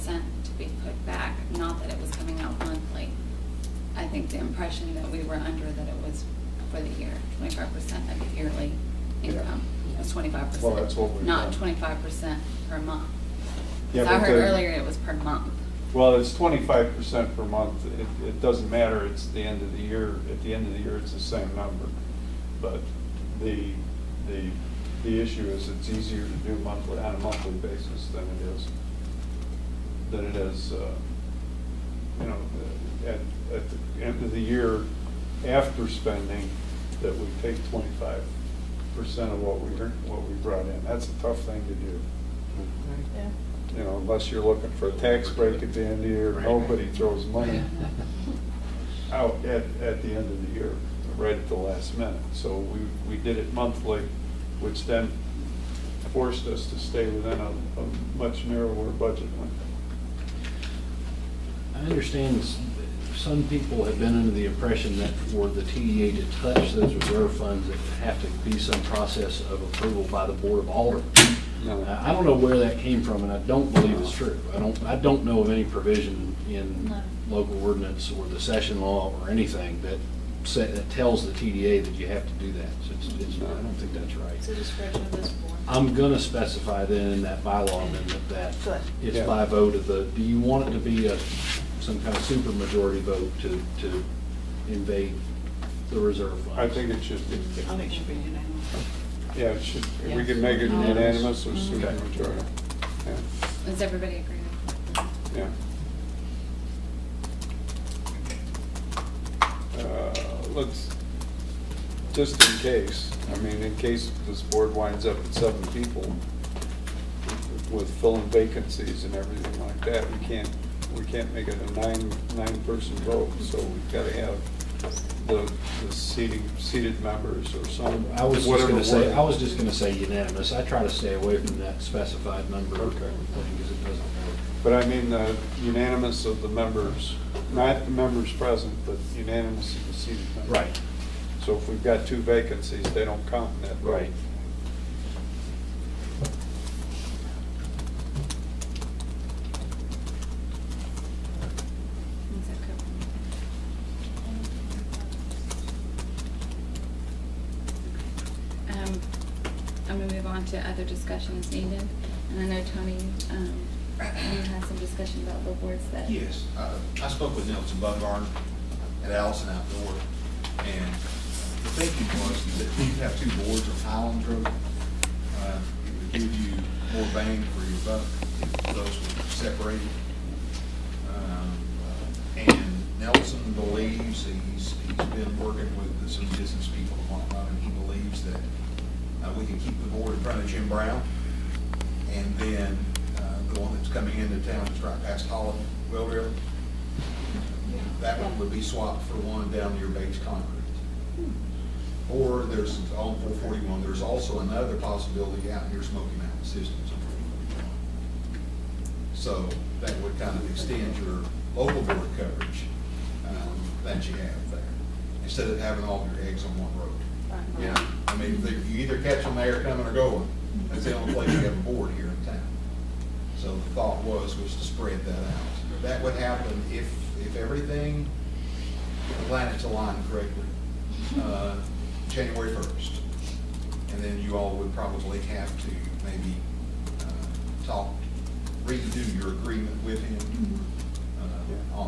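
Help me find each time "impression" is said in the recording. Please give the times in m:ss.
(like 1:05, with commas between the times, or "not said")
0:04, 1:04.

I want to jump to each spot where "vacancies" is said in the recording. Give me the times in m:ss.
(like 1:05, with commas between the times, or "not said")
1:58, 2:22.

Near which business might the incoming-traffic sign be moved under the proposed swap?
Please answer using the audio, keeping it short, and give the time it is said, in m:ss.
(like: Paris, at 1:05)
Bates Concrete, at 3:19.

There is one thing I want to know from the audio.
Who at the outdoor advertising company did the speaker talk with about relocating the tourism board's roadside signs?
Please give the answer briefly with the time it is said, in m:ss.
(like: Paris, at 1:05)
Nelson Buckhorn, at 2:47.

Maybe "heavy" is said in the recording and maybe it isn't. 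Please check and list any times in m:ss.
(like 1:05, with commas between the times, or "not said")
not said.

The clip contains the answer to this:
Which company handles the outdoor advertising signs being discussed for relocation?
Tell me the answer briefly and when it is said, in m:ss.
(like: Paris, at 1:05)
Allison Outdoor, at 2:49.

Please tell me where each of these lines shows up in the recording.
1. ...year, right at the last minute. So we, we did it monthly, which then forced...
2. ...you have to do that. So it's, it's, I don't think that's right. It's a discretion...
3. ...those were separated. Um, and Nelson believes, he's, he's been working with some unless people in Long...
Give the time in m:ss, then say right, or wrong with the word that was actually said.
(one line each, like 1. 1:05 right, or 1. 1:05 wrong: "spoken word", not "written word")
1. 0:50 right
2. 1:21 right
3. 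2:58 wrong: "business", not "unless".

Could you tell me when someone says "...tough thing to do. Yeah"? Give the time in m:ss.
0:41.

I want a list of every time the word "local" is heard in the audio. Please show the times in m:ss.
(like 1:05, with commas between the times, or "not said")
1:17, 3:31.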